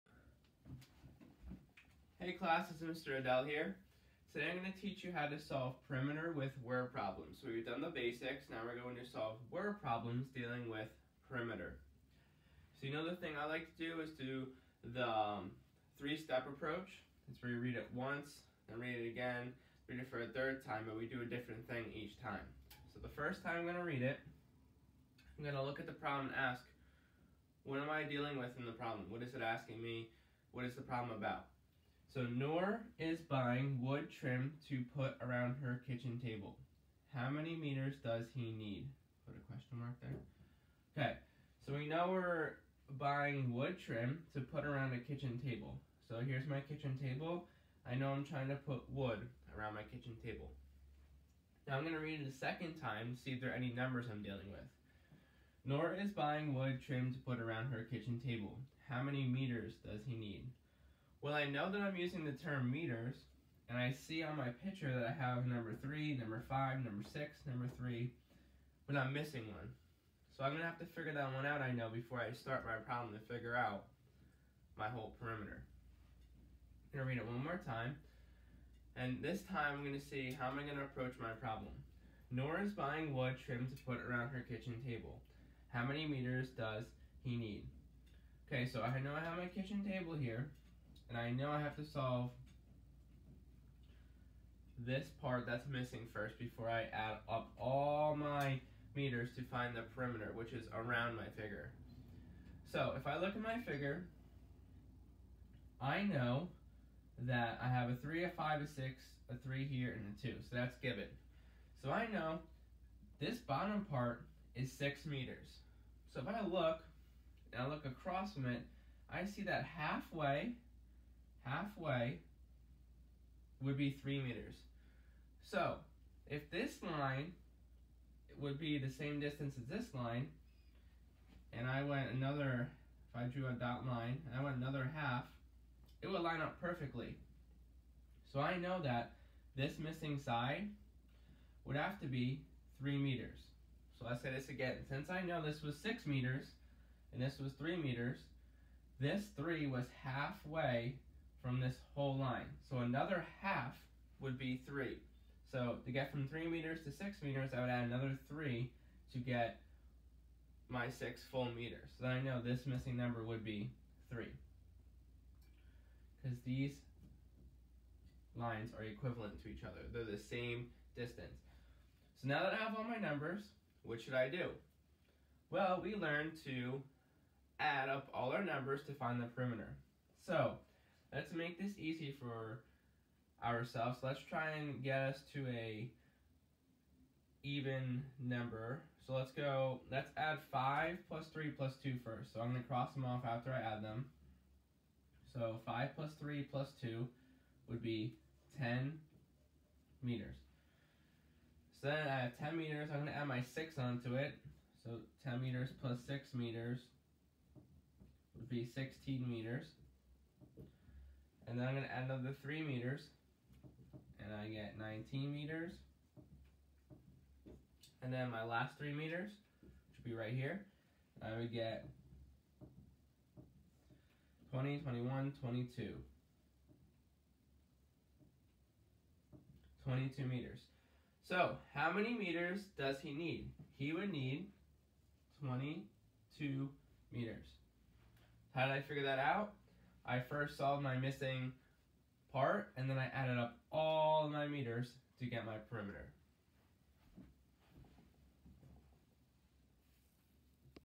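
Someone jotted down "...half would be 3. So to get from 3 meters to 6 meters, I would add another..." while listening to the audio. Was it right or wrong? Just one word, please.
right.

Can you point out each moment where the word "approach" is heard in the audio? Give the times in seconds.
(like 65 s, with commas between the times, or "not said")
16 s, 80 s.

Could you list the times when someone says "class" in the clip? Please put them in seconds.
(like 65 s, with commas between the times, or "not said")
2 s.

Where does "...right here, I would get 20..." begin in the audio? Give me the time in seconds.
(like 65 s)
220 s.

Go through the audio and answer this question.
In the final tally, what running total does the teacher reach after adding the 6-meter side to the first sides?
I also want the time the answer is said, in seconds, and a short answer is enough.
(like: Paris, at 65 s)
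16 meters, at 208 s.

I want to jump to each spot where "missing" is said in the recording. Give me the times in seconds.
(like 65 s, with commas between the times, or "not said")
69 s, 95 s, 139 s, 162 s, 240 s.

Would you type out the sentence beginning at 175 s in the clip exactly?
Well, we learned to add up all our numbers to find the perimeter let's make this easy for ourselves.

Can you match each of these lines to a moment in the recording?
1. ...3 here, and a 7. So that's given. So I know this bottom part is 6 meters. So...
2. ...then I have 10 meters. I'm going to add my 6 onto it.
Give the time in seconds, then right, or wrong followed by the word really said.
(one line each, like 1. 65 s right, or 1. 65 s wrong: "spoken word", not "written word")
1. 109 s wrong: "2", not "7"
2. 201 s right.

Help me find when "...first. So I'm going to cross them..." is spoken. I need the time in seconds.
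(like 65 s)
192 s.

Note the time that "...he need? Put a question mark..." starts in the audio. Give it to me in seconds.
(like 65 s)
38 s.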